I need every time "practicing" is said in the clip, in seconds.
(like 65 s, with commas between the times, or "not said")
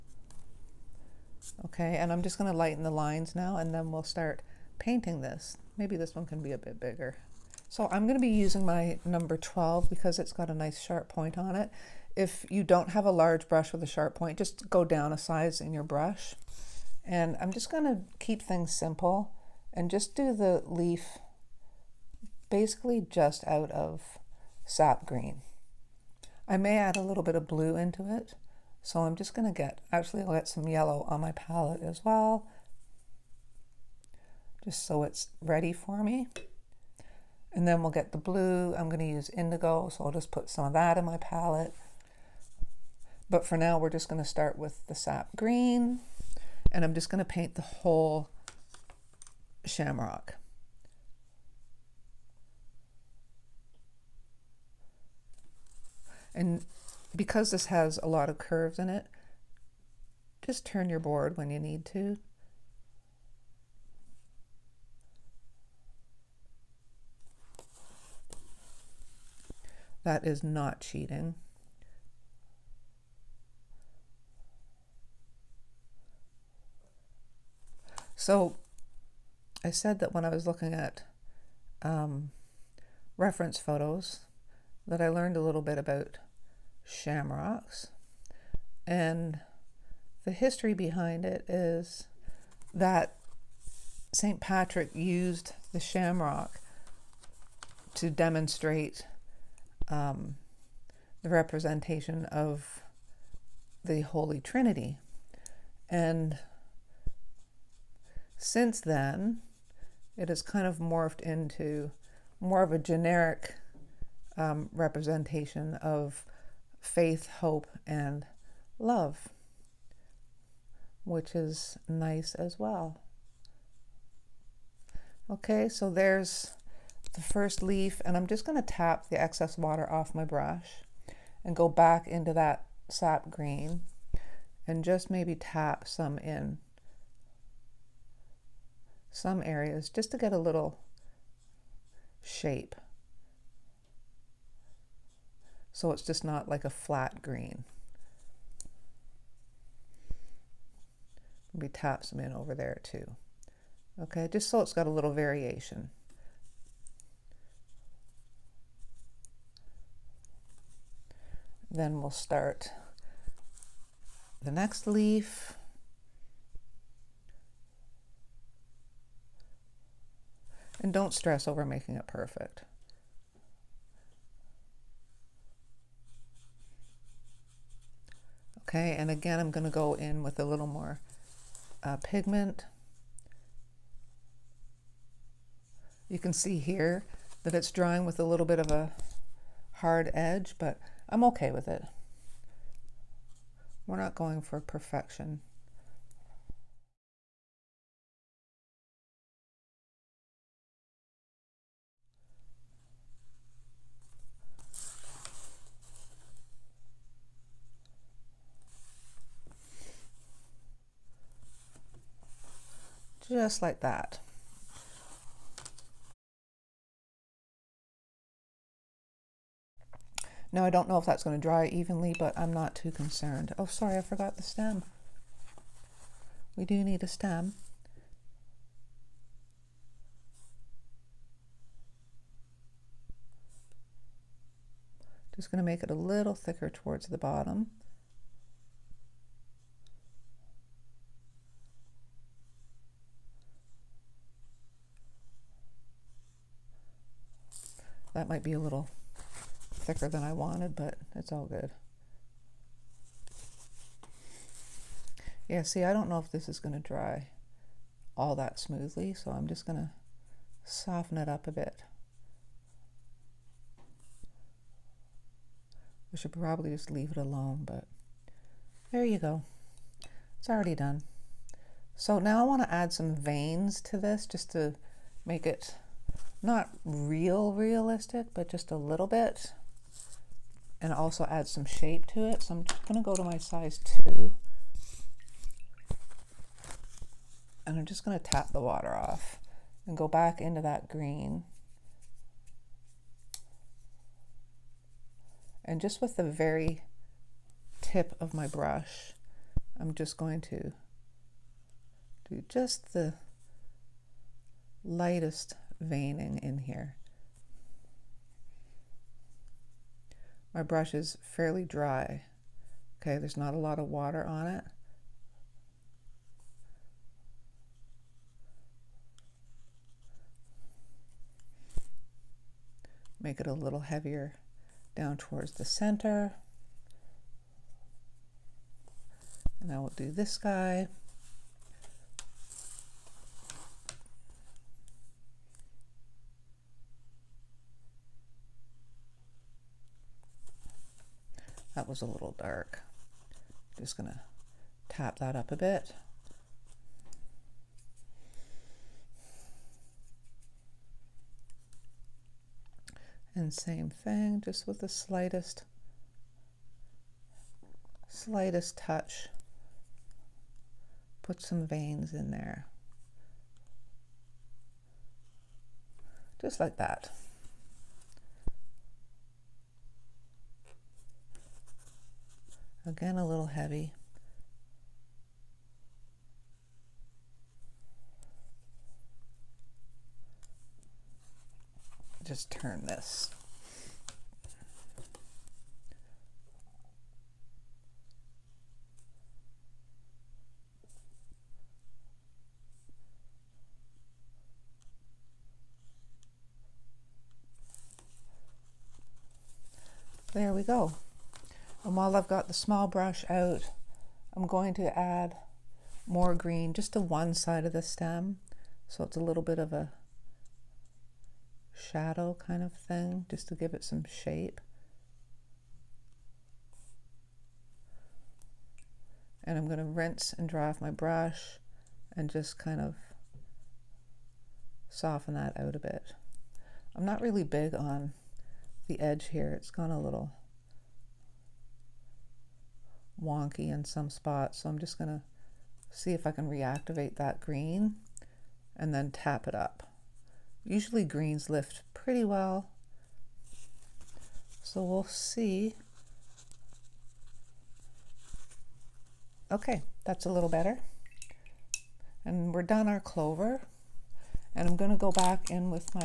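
not said.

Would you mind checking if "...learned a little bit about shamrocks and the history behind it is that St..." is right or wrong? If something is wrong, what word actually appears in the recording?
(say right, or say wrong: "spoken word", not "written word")
right.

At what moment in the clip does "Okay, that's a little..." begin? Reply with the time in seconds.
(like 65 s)
449 s.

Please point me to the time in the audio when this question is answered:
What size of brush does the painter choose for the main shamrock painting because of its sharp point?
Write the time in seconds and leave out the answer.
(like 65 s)
9 s.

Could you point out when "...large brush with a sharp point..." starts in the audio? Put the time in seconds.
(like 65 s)
13 s.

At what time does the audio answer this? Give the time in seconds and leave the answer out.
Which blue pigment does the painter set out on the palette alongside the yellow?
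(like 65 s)
39 s.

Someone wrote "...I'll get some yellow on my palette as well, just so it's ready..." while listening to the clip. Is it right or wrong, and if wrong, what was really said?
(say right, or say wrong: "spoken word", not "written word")
right.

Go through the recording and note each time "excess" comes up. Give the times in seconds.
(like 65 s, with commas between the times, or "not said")
129 s.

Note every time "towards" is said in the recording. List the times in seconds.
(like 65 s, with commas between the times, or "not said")
236 s, 325 s.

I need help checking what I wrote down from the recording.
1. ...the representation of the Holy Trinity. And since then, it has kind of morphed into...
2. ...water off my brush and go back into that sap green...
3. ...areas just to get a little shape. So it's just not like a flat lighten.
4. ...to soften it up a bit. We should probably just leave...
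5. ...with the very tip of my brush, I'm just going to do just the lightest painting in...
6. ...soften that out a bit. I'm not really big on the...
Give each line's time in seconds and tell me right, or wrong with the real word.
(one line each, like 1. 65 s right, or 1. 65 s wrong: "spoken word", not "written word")
1. 101 s right
2. 129 s right
3. 139 s wrong: "green", not "lighten"
4. 259 s right
5. 296 s wrong: "veining", not "painting"
6. 424 s right.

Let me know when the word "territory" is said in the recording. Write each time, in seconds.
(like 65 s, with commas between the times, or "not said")
not said.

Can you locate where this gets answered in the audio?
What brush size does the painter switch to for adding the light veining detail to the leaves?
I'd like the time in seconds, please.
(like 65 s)
283 s.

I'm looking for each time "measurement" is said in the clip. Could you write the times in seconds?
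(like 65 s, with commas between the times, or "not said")
not said.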